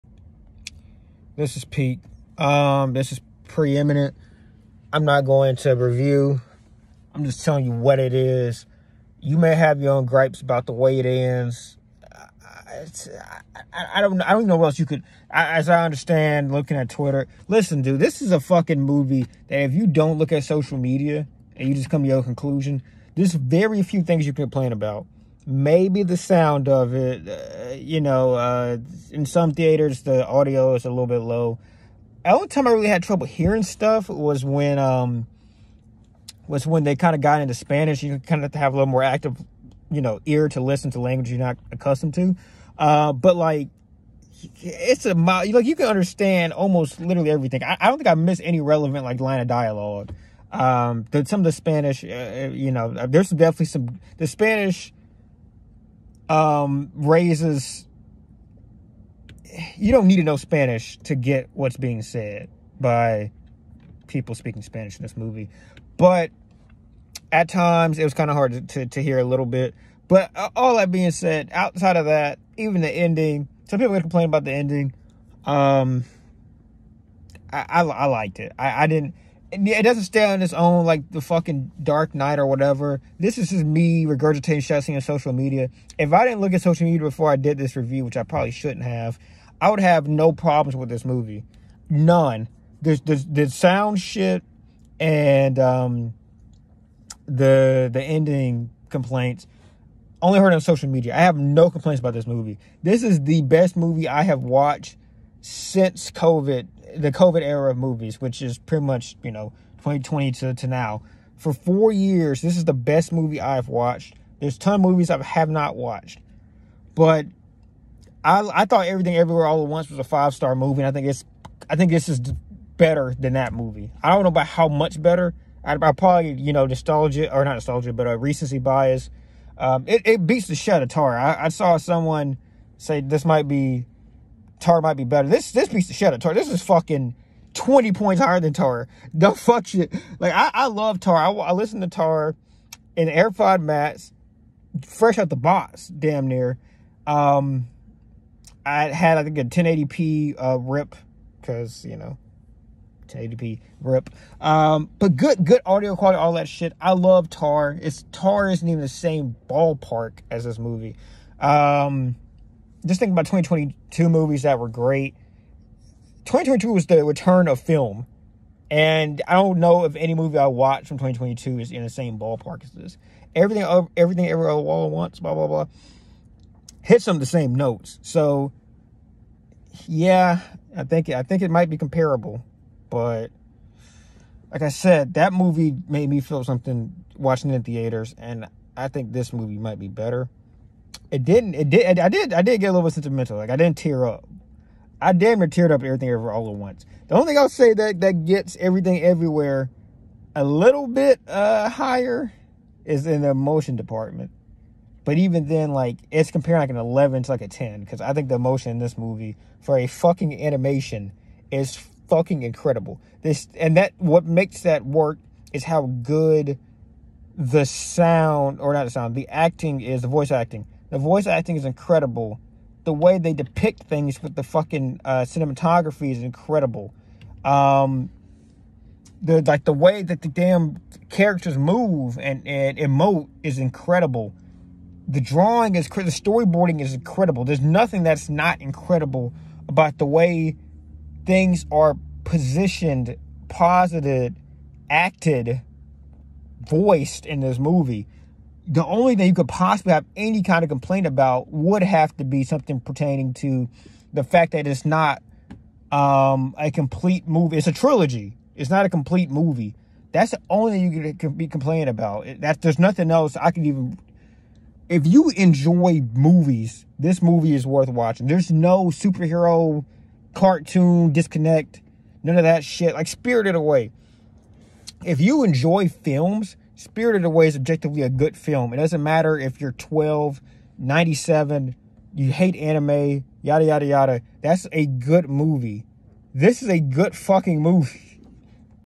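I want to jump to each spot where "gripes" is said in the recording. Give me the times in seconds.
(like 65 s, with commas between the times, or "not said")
10 s.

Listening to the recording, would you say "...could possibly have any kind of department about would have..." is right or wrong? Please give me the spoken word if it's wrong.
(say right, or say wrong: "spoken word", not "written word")
wrong: "complaint", not "department".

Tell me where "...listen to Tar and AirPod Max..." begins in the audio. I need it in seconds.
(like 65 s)
141 s.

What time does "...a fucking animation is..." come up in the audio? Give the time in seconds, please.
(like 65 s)
209 s.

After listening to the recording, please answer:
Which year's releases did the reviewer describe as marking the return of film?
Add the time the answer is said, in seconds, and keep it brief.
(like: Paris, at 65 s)
2022, at 166 s.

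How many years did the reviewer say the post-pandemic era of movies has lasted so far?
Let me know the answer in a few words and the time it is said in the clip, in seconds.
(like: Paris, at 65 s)
4, at 111 s.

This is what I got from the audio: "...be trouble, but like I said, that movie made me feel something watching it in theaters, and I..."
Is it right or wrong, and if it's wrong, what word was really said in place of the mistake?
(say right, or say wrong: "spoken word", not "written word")
wrong: "comparable", not "trouble".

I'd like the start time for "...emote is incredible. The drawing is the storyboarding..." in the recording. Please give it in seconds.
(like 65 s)
232 s.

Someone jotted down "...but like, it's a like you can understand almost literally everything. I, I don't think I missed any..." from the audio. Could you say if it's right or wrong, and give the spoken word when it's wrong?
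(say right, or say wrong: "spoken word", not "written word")
right.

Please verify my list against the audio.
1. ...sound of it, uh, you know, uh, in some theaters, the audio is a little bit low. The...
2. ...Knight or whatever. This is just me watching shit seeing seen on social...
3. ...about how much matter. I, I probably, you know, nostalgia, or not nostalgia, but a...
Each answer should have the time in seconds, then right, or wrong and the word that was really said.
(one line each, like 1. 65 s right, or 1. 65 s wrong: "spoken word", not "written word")
1. 26 s right
2. 82 s wrong: "regurgitating", not "watching"
3. 124 s wrong: "better", not "matter".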